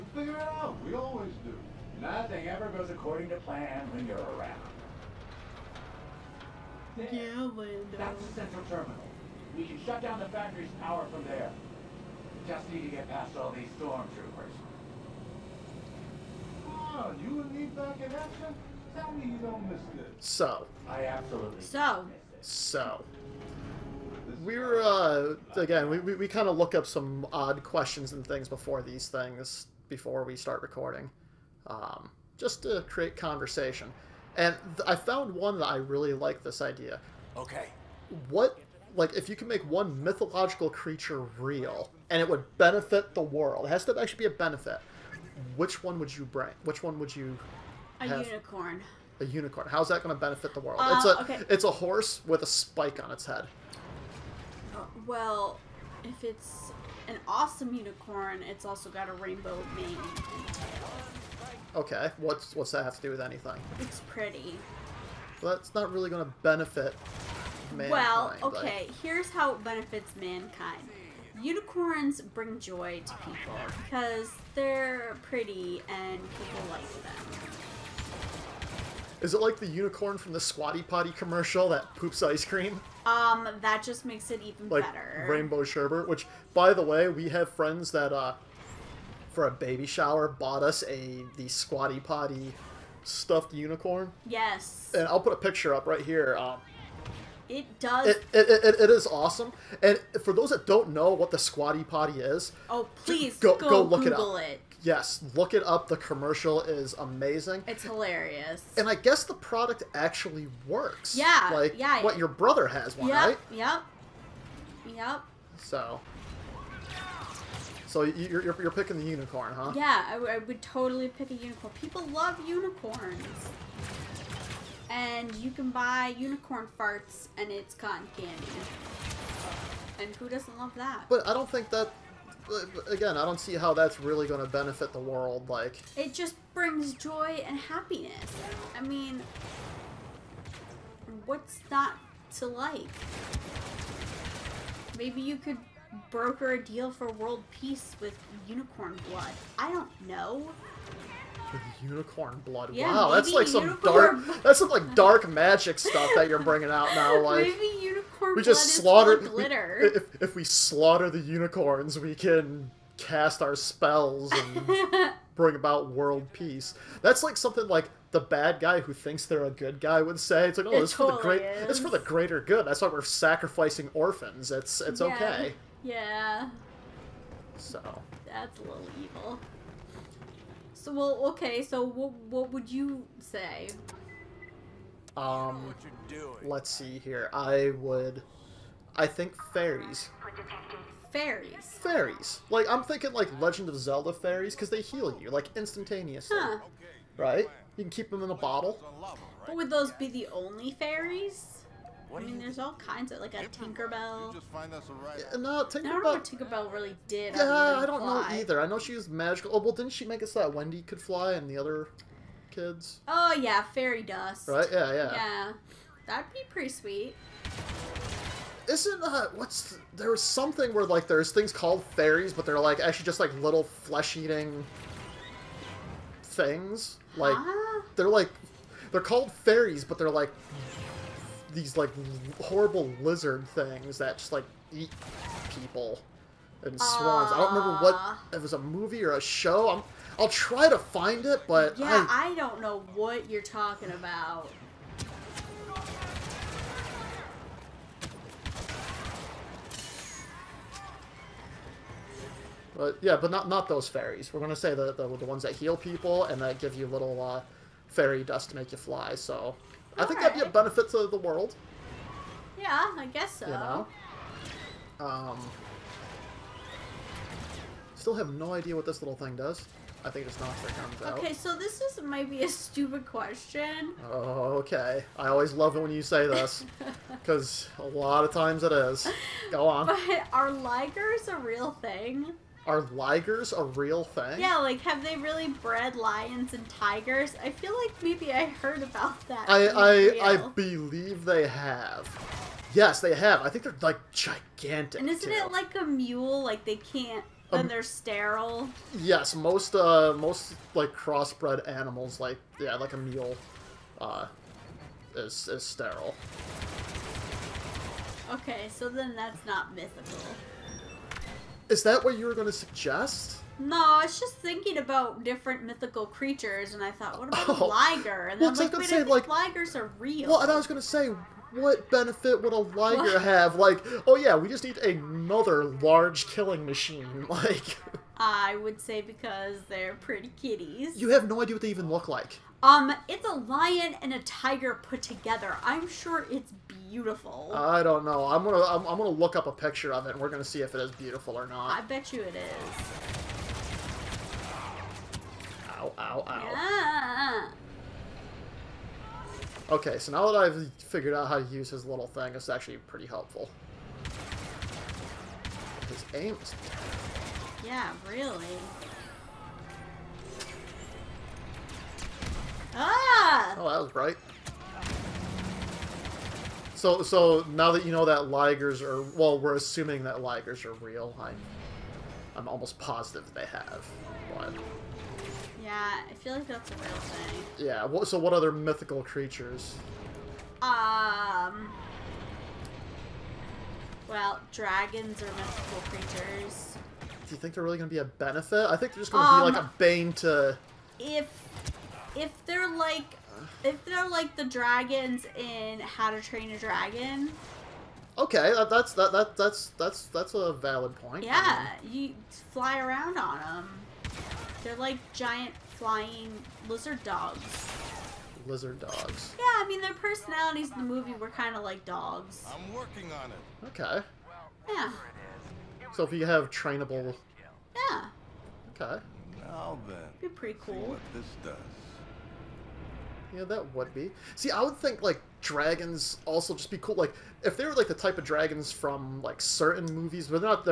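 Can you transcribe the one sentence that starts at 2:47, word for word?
That's like something like the bad guy who thinks they're a good guy would say.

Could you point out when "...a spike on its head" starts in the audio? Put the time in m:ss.
0:52.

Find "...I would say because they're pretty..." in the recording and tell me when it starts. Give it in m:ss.
5:28.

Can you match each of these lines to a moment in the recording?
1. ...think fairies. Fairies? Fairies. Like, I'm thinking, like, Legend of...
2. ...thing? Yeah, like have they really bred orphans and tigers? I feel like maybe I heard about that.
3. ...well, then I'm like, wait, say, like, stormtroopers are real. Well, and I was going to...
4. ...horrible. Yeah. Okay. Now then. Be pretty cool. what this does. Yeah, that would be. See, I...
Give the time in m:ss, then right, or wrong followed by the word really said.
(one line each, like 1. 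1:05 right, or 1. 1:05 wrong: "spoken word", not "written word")
1. 3:09 right
2. 4:44 wrong: "lions", not "orphans"
3. 5:18 wrong: "ligers", not "stormtroopers"
4. 6:56 wrong: "trainable", not "horrible".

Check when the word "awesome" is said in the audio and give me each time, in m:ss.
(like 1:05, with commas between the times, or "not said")
0:57, 1:39.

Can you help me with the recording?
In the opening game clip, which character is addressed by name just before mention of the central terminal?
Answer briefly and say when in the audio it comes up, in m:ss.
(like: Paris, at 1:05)
Lando, at 0:07.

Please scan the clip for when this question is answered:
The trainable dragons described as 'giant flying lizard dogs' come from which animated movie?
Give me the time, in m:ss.
6:35.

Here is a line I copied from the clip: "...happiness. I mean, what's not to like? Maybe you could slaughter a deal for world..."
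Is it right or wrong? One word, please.
wrong.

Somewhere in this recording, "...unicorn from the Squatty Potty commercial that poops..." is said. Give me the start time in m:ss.
1:19.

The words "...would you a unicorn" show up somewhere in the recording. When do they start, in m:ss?
0:46.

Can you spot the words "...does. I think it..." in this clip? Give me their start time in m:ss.
4:29.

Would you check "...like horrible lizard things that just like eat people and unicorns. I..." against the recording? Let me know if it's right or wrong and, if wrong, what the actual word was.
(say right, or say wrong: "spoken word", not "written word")
wrong: "swans", not "unicorns".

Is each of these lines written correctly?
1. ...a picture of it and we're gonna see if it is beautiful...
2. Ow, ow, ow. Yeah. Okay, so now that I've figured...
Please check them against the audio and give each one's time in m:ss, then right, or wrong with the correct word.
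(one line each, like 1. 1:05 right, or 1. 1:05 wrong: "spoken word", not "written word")
1. 5:39 right
2. 5:45 right.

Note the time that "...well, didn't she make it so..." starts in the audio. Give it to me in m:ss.
3:29.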